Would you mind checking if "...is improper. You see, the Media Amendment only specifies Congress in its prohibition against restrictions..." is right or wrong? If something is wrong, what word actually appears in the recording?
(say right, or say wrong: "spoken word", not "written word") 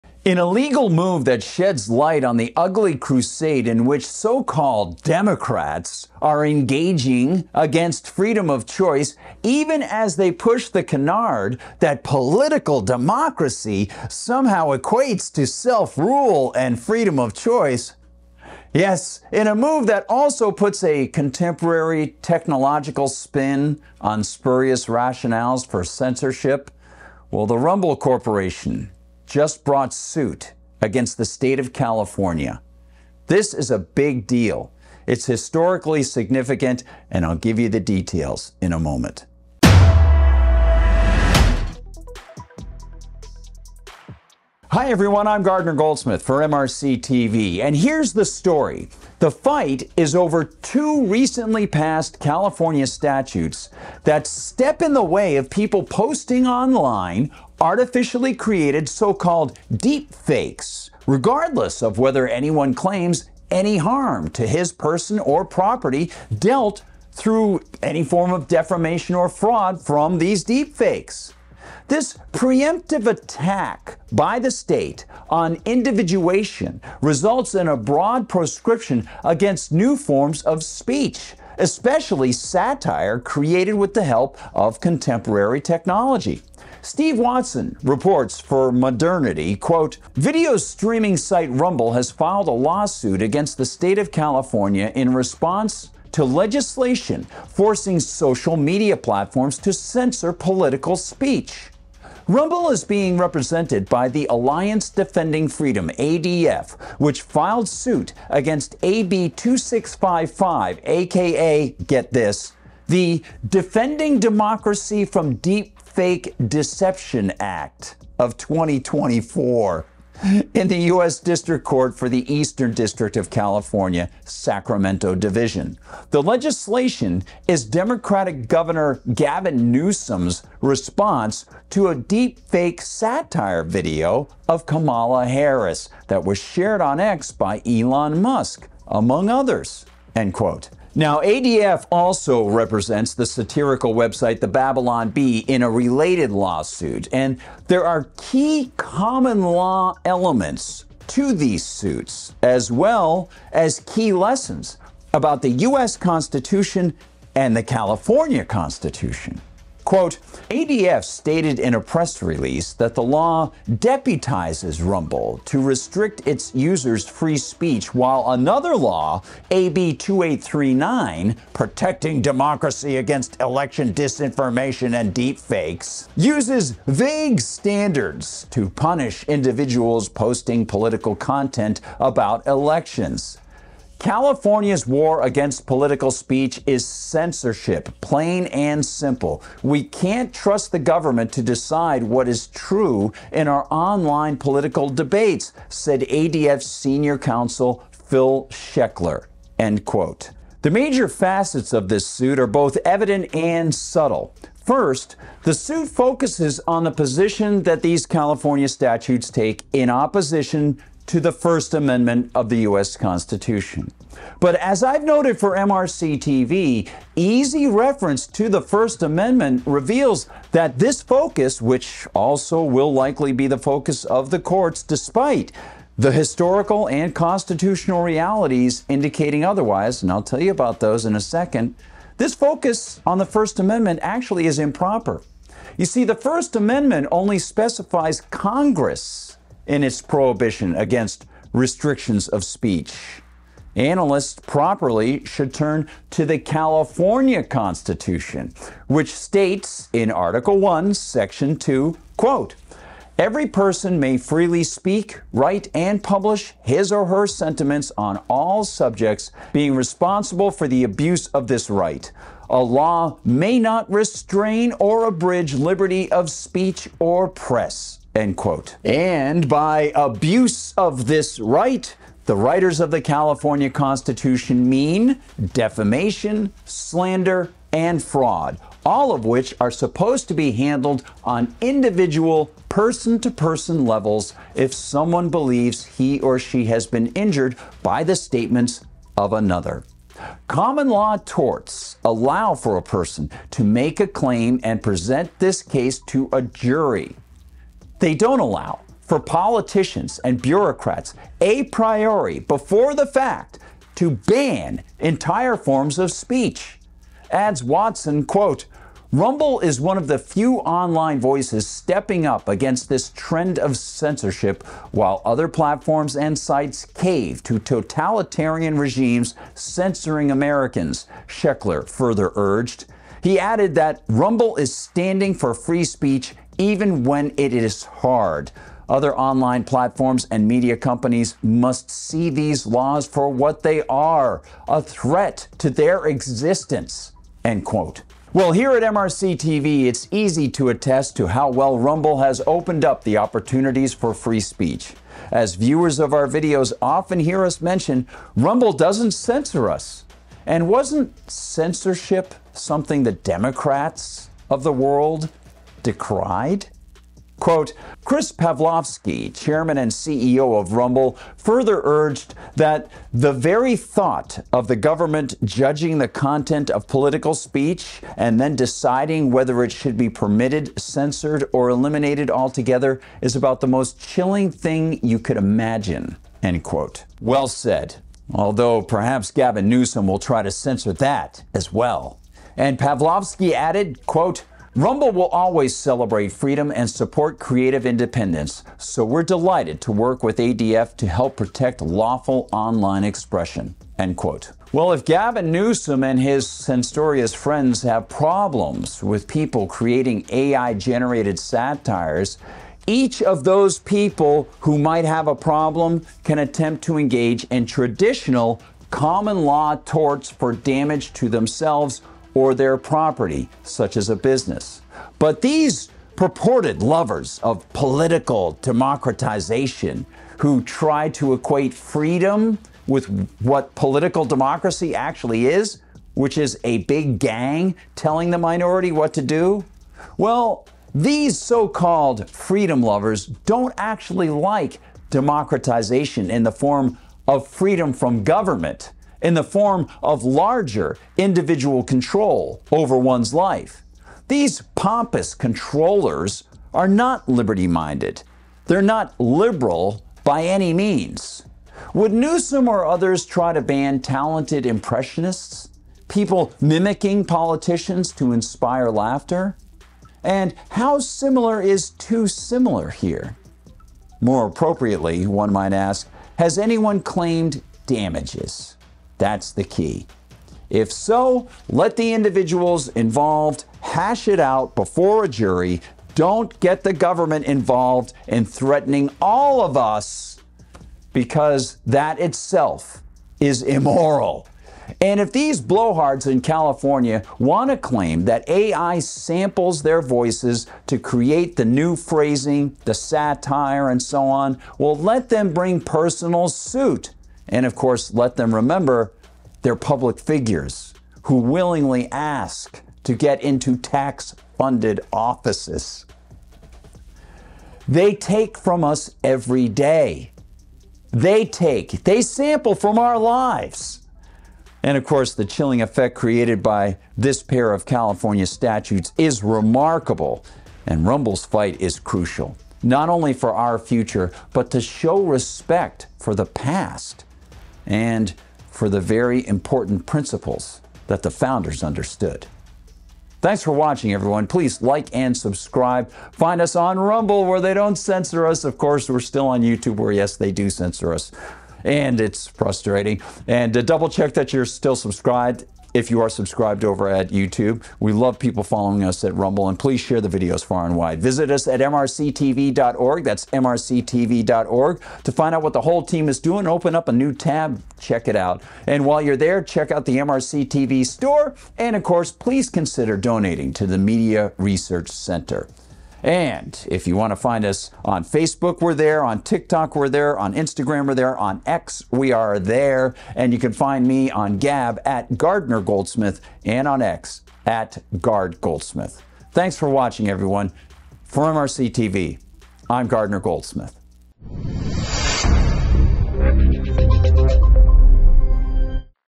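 wrong: "First", not "Media".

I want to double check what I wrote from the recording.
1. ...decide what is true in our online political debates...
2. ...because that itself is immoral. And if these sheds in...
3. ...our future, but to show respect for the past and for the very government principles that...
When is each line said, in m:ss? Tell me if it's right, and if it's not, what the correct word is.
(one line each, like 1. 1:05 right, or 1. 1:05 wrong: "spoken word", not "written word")
1. 3:11 right
2. 8:01 wrong: "blowhards", not "sheds"
3. 8:43 wrong: "important", not "government".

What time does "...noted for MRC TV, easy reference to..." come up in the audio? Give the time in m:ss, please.
3:35.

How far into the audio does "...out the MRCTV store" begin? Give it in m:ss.
9:19.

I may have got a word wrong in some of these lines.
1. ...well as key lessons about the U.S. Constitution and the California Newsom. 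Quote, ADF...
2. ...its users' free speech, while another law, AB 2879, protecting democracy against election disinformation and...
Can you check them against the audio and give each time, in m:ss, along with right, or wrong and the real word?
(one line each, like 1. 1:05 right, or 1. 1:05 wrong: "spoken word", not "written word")
1. 2:32 wrong: "Constitution", not "Newsom"
2. 2:46 wrong: "2839", not "2879".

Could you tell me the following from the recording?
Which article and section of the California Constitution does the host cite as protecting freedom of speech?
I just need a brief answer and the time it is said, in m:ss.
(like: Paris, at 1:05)
Article 1, Section 2, at 4:10.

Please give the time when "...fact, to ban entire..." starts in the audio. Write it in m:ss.
5:03.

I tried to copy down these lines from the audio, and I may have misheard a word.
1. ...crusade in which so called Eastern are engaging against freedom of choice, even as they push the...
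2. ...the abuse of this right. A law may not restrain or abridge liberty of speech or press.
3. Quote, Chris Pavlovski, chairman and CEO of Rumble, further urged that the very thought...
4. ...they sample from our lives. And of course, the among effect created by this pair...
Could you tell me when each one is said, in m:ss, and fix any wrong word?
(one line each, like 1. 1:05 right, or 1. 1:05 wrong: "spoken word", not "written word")
1. 0:02 wrong: "Democrats", not "Eastern"
2. 4:20 right
3. 5:57 right
4. 8:32 wrong: "chilling", not "among".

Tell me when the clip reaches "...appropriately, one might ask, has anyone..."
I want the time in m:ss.
7:44.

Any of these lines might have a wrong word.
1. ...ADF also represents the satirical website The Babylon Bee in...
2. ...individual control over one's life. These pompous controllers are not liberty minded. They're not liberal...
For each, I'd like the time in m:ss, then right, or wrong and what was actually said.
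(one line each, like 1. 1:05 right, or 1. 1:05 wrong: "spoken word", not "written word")
1. 2:21 right
2. 7:21 right.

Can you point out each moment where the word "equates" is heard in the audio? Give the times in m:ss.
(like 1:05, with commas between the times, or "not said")
0:14, 7:01.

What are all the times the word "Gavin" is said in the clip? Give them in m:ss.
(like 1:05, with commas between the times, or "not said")
2:09, 6:19, 6:35.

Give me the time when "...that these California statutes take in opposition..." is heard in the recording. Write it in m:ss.
3:27.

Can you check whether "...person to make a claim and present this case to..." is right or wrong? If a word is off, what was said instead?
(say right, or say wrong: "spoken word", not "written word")
right.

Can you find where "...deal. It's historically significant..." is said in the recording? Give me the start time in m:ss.
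0:34.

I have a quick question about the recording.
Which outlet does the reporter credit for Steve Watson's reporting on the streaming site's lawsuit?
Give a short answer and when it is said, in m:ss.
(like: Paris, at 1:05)
Modernity, at 1:28.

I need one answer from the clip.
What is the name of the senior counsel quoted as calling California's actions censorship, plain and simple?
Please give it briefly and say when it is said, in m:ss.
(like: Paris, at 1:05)
Phil Sechler, at 3:17.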